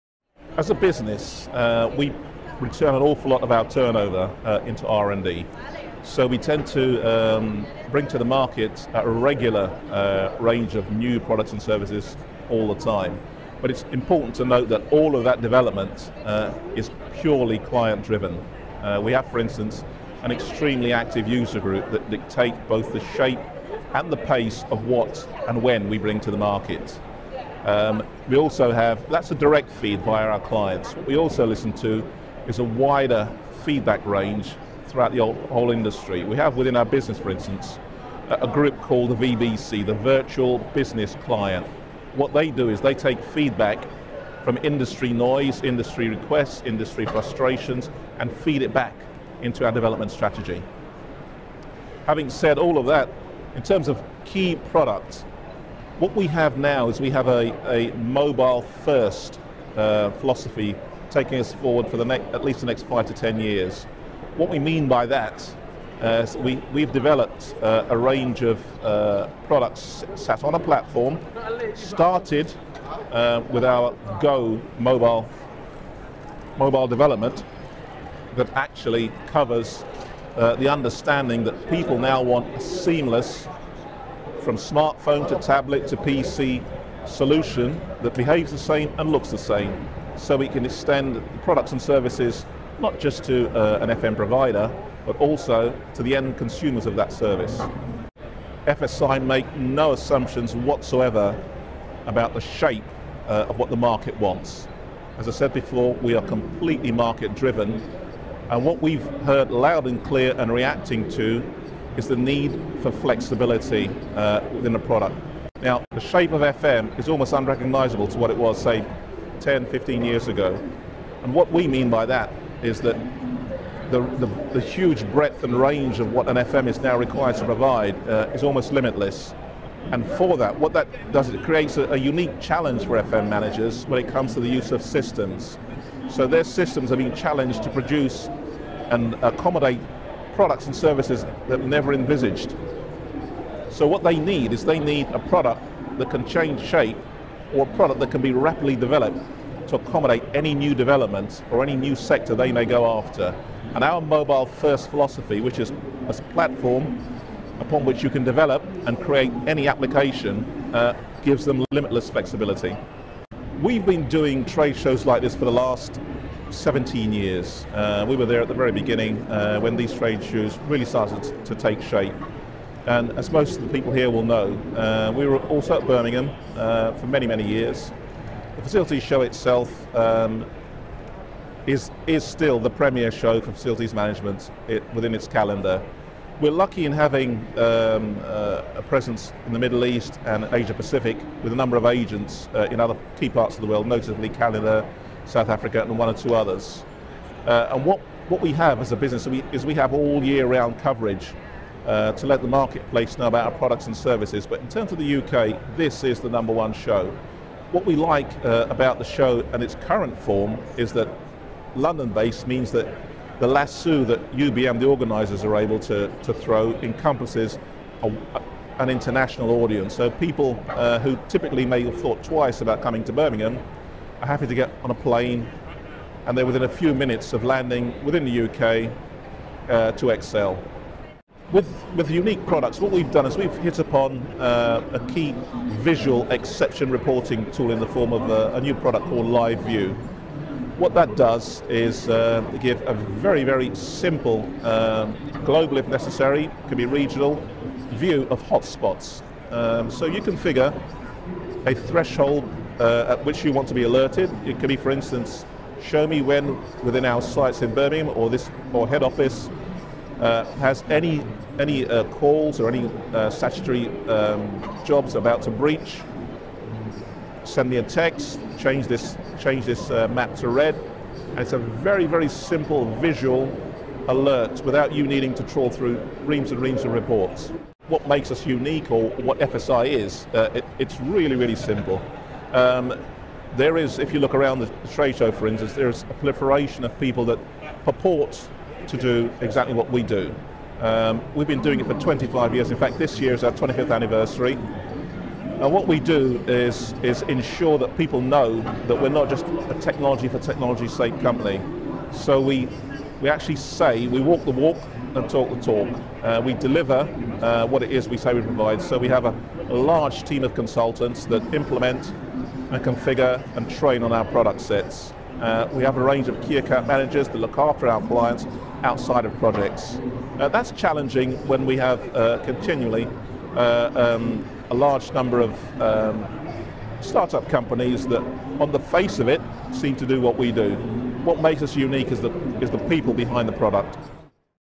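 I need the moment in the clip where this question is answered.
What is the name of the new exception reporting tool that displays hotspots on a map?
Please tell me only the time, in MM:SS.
03:59.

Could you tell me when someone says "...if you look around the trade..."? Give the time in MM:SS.
04:43.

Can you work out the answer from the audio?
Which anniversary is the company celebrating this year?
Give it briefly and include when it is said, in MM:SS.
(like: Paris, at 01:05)
25th, at 04:53.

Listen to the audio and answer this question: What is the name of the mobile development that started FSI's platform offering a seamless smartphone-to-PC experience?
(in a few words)
Go mobile.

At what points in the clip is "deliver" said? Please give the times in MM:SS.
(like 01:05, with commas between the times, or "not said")
05:06.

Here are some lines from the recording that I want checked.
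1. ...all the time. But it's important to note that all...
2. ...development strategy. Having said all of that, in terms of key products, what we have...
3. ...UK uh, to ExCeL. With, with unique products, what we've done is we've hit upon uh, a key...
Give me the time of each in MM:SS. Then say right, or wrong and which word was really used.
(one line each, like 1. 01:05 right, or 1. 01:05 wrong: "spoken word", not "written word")
1. 00:12 right
2. 00:49 right
3. 03:48 right.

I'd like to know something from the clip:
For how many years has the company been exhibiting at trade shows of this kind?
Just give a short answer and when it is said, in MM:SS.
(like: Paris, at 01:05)
17, at 02:46.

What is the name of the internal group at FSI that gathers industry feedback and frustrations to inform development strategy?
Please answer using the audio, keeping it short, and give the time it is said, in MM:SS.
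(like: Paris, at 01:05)
Virtual Business Client, at 00:39.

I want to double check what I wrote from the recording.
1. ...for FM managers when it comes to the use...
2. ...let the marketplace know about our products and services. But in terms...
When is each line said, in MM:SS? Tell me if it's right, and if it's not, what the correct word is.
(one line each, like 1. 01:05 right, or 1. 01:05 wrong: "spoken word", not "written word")
1. 02:12 right
2. 03:22 right.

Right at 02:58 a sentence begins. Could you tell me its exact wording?
The facilities show itself um, is, is still the premier show for facilities management it, within its calendar.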